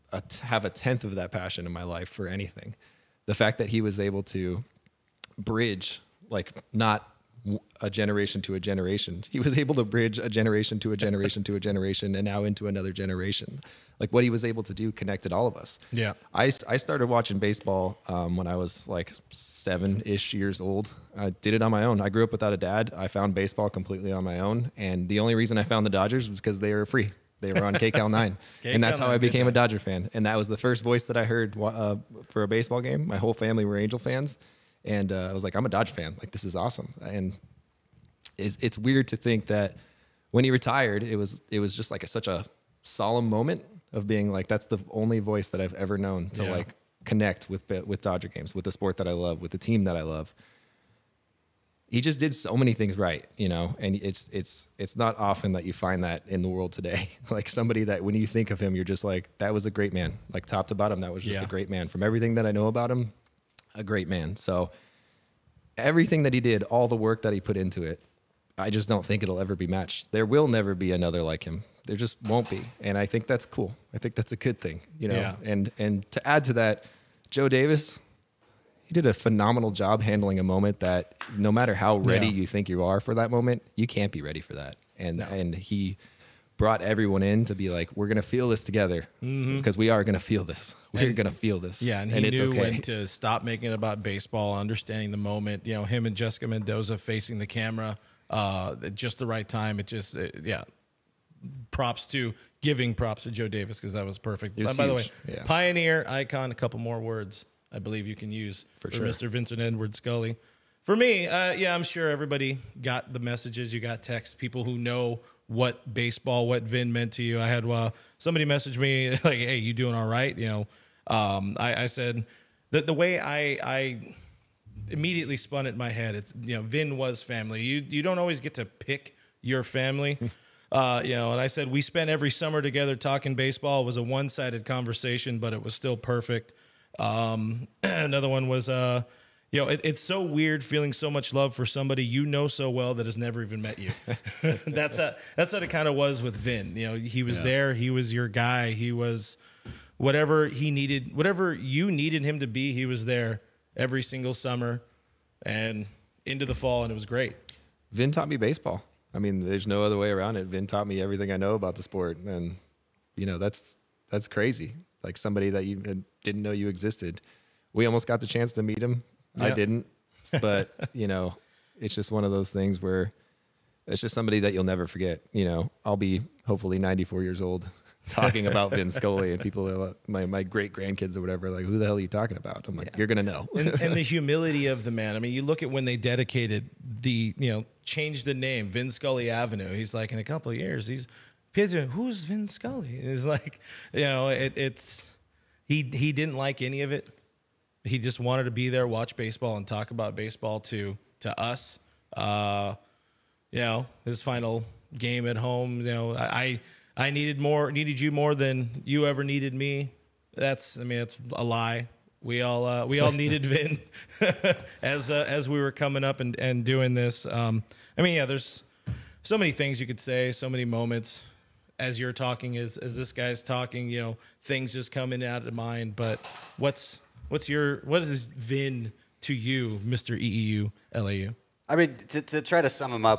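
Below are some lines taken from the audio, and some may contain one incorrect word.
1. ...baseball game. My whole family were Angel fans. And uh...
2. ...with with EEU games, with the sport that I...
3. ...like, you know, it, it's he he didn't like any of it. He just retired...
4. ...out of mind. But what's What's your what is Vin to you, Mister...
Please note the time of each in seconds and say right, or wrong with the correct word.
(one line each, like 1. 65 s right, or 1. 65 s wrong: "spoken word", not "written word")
1. 32 s right
2. 47 s wrong: "Dodger", not "EEU"
3. 193 s wrong: "wanted", not "retired"
4. 225 s right.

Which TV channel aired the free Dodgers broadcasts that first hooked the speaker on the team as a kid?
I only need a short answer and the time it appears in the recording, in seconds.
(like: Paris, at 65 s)
KCAL 9, at 27 s.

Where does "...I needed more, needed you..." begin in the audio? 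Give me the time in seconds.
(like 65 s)
206 s.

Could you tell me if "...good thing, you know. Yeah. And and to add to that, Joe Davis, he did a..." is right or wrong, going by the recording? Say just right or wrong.
right.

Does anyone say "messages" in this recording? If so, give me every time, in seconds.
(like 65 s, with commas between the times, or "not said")
113 s, 118 s.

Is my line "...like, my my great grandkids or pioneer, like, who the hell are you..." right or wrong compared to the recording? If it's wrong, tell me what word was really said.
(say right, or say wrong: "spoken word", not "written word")
wrong: "whatever", not "pioneer".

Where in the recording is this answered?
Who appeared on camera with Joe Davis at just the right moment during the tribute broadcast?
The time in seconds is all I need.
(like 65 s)
96 s.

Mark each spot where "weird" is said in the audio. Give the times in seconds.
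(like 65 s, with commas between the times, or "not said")
38 s, 140 s.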